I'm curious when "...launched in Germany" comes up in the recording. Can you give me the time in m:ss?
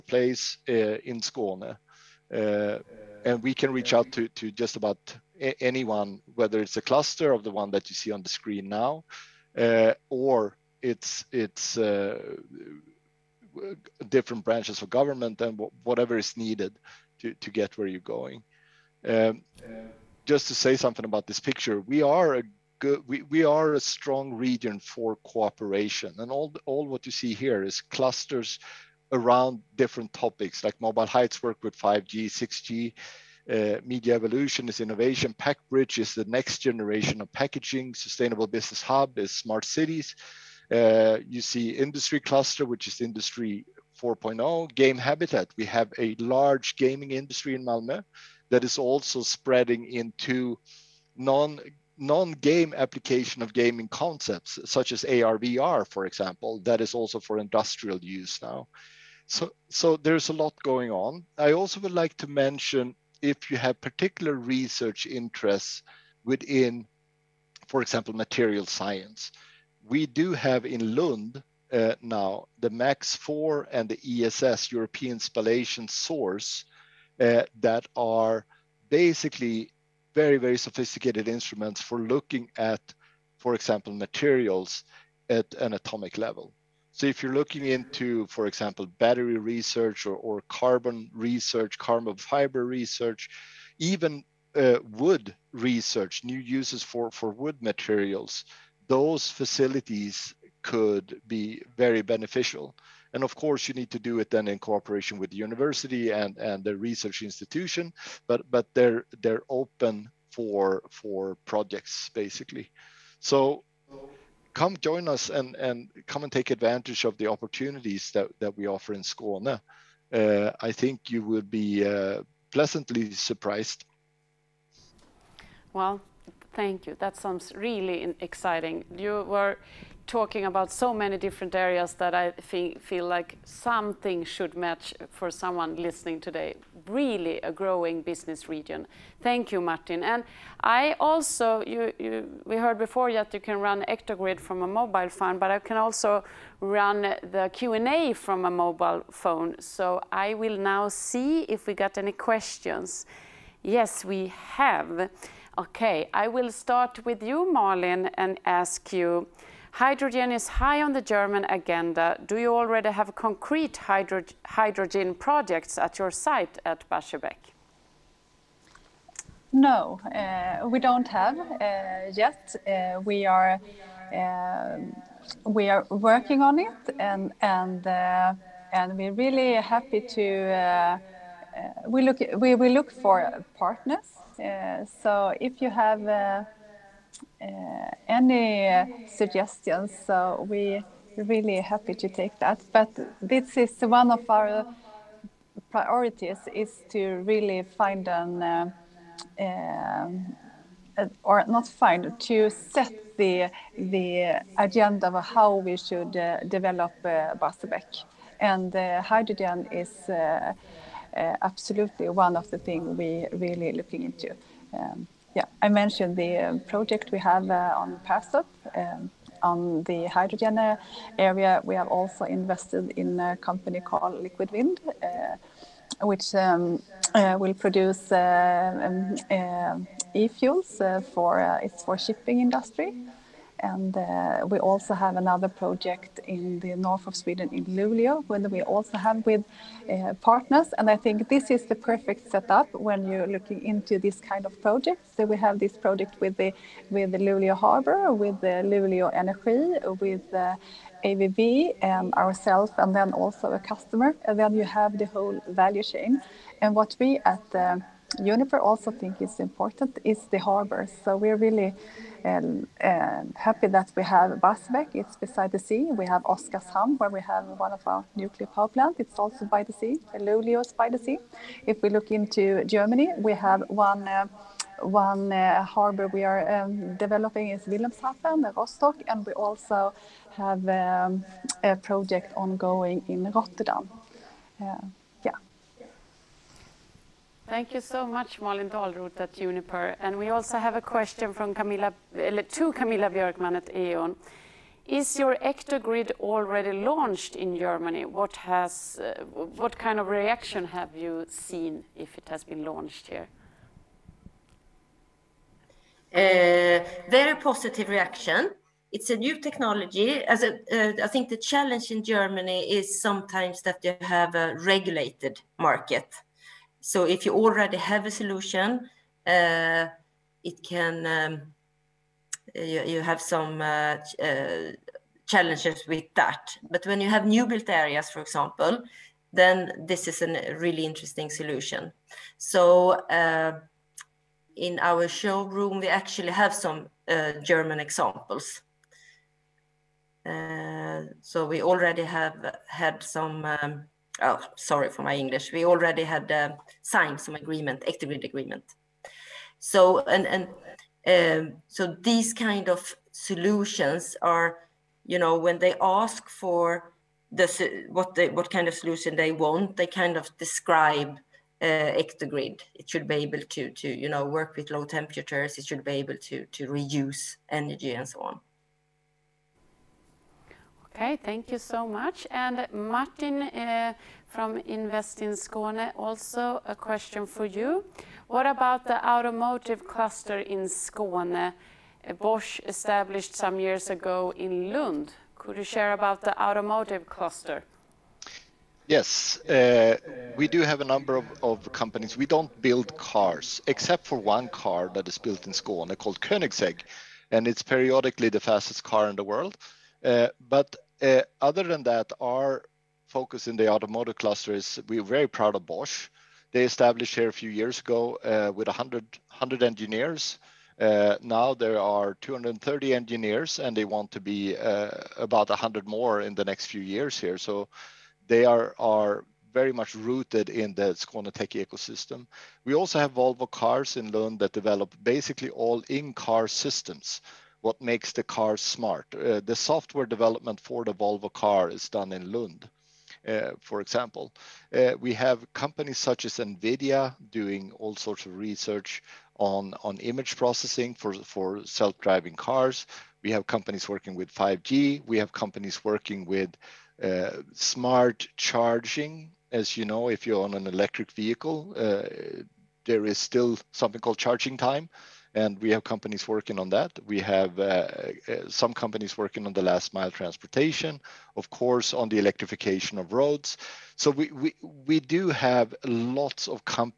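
4:56.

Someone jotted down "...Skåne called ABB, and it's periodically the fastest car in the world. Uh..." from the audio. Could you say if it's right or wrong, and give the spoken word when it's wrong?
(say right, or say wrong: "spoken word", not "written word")
wrong: "Koenigsegg", not "ABB".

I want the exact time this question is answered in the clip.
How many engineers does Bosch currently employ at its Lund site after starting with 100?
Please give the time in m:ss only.
6:52.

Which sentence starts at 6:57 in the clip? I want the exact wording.
So they are very much rooted in the Tech ecosystem.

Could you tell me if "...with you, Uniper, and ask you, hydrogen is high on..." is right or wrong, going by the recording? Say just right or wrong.
wrong.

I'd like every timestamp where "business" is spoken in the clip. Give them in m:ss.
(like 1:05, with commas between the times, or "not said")
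0:38, 2:18.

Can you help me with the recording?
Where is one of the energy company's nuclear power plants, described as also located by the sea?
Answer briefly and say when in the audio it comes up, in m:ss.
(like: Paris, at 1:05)
Oskarshamn, at 4:26.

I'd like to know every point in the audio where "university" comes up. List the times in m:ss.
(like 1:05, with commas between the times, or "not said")
1:45.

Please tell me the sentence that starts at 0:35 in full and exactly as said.
PackBridge is the next generation of packaging.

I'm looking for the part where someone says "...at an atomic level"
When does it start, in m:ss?
1:25.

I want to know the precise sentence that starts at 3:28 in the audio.
and hydrogen is Eh, absolutely one of the things we really looking into.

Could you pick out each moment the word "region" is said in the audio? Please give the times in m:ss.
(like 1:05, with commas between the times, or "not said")
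0:24, 2:18.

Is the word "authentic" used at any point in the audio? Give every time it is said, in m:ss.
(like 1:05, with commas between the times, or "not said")
not said.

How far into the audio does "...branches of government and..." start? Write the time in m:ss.
0:14.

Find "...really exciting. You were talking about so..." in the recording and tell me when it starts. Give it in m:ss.
2:07.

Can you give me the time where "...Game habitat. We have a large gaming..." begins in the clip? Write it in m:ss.
0:44.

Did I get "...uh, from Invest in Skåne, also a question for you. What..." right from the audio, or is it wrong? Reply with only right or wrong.
right.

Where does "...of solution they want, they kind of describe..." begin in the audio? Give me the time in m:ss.
5:58.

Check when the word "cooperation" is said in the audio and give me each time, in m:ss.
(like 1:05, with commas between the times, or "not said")
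0:25, 1:44.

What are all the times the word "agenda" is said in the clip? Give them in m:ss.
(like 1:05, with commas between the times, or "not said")
2:41, 3:24.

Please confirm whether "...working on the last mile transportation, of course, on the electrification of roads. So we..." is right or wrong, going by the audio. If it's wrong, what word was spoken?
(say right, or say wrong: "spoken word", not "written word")
right.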